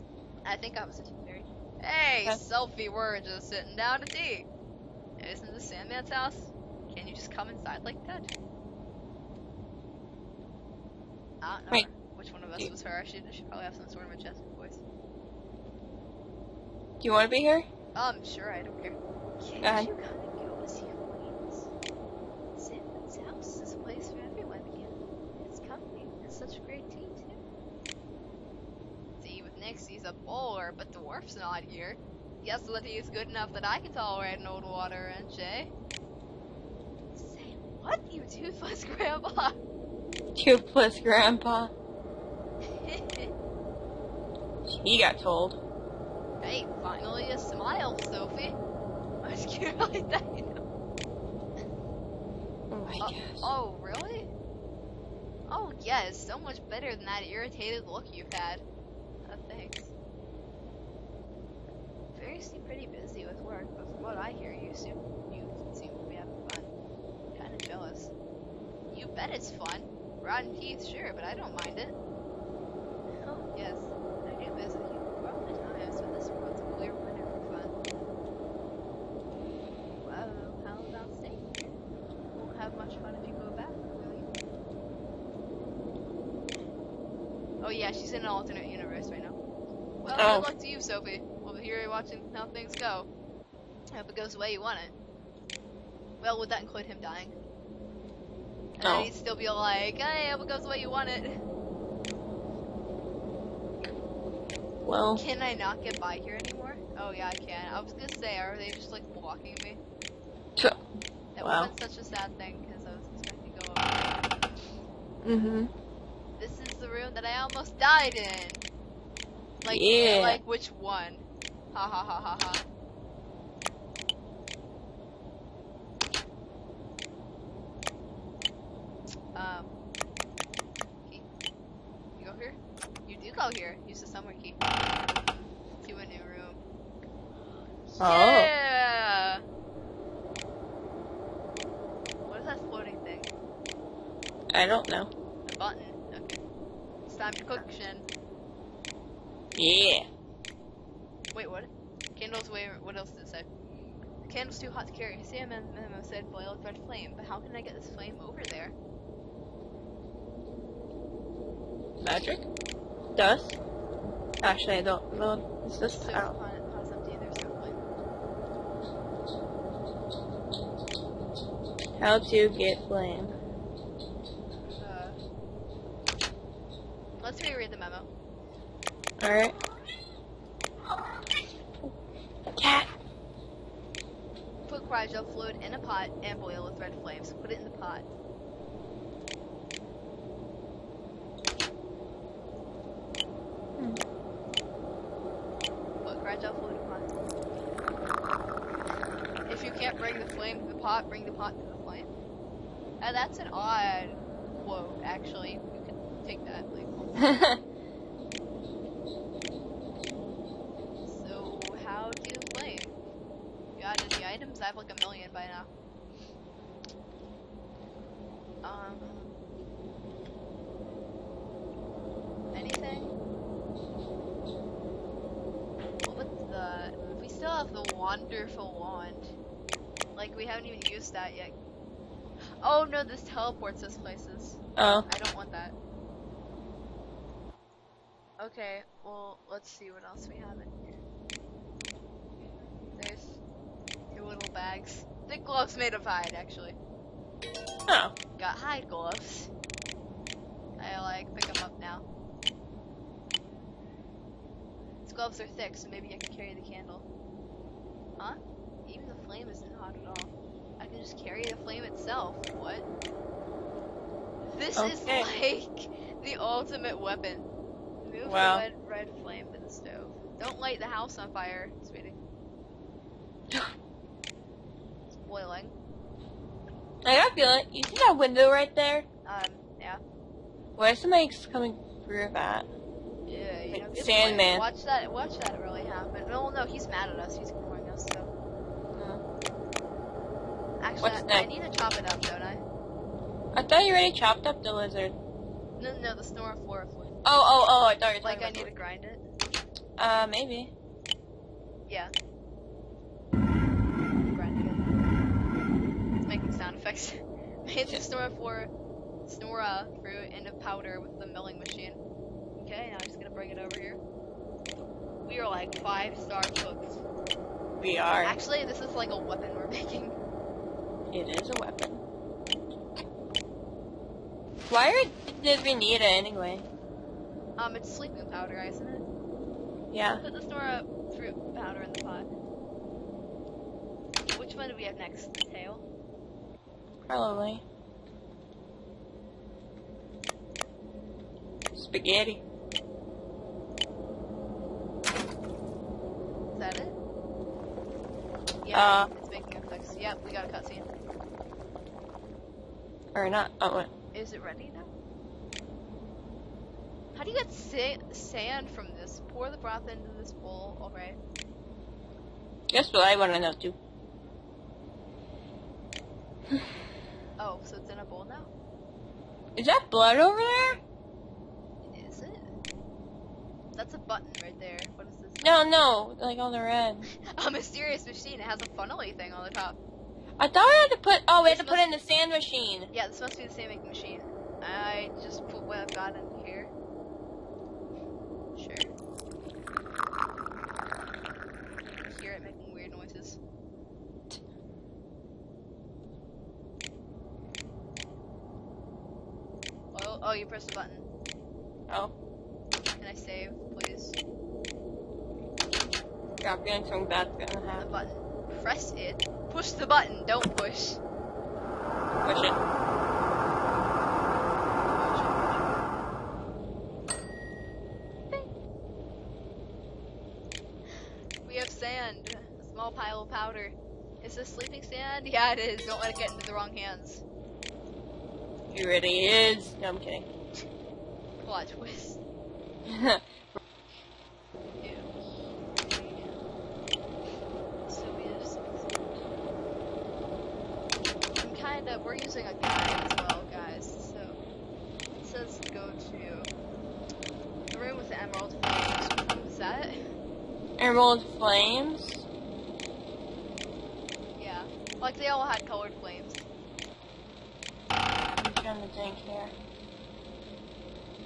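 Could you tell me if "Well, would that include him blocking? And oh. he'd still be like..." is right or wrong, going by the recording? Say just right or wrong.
wrong.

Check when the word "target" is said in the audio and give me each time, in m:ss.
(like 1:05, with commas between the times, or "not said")
not said.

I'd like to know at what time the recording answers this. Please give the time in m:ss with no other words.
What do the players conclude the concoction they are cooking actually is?
5:27.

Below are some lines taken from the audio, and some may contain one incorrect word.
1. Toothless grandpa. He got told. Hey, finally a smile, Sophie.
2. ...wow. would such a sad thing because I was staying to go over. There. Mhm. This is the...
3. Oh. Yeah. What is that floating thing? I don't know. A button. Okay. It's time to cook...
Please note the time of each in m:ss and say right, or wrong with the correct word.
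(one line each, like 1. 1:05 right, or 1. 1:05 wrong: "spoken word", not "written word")
1. 0:40 right
2. 1:51 wrong: "expecting", not "staying"
3. 2:18 right.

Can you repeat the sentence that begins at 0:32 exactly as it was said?
Yes, Liddy is good enough that I can tolerate an old water wrench, eh?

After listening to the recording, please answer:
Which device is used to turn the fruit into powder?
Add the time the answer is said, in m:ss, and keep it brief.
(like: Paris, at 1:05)
Milling machine, at 5:11.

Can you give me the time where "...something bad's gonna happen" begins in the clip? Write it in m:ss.
6:46.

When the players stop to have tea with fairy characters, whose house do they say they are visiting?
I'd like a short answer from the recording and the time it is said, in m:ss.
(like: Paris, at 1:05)
Sandman's house, at 0:05.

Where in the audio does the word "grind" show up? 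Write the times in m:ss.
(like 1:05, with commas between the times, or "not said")
4:58, 5:03.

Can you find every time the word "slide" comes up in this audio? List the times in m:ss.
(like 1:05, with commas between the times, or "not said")
not said.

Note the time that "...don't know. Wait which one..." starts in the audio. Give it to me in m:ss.
0:11.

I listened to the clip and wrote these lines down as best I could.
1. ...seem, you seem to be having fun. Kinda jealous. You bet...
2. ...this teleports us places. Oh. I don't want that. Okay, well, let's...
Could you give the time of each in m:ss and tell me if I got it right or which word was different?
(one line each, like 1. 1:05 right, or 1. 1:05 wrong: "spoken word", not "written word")
1. 1:04 right
2. 3:53 right.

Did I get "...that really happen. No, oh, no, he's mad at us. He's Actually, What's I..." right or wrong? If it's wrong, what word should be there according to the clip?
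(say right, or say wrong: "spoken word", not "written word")
right.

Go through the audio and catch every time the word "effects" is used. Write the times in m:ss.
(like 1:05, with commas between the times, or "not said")
5:06, 5:49.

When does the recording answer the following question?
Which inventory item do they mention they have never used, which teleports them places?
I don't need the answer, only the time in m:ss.
3:47.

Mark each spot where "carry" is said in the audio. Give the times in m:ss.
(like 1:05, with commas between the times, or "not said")
2:34, 4:16, 4:21.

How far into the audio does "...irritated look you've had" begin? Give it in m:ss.
0:57.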